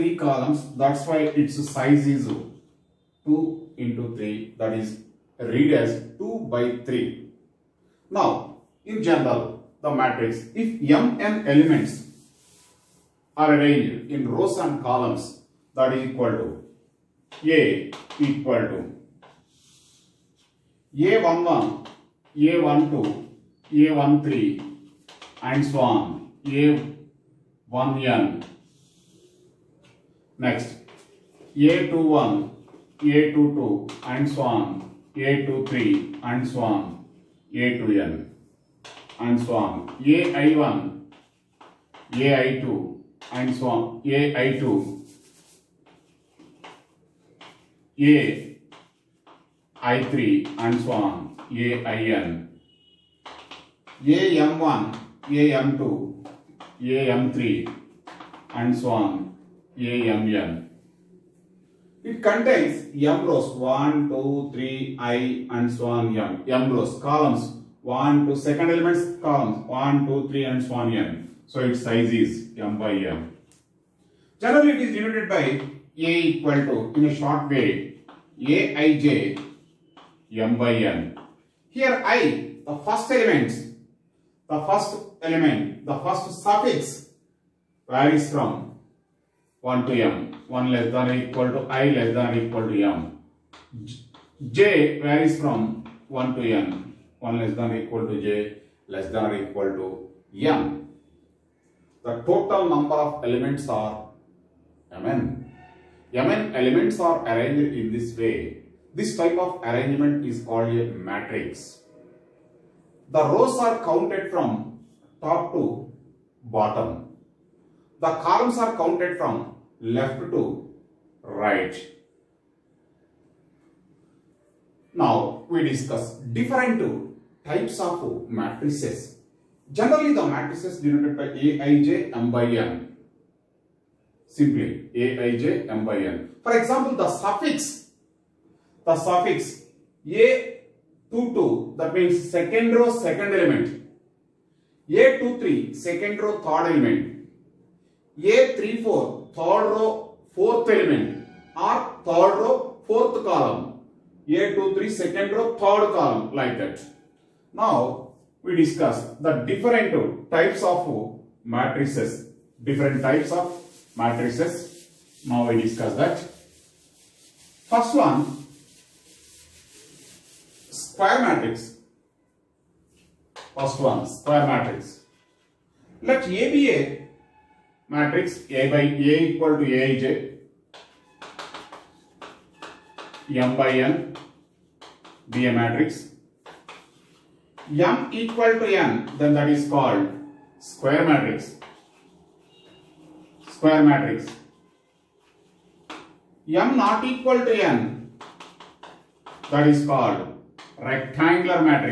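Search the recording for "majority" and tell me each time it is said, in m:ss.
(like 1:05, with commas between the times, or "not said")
not said.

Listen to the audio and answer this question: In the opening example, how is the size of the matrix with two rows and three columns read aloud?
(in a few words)
2 by 3.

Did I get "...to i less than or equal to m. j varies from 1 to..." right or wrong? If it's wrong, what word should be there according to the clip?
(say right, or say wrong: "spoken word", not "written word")
right.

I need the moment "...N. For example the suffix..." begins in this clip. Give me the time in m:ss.
2:15.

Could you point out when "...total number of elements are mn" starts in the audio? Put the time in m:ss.
1:42.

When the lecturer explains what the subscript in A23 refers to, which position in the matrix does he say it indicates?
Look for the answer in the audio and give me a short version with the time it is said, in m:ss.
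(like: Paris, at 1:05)
second row third element, at 2:24.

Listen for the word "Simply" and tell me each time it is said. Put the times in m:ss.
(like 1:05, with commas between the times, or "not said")
2:14.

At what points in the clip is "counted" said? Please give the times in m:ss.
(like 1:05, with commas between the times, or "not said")
1:53, 1:58.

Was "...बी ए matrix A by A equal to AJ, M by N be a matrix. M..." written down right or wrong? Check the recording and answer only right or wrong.
right.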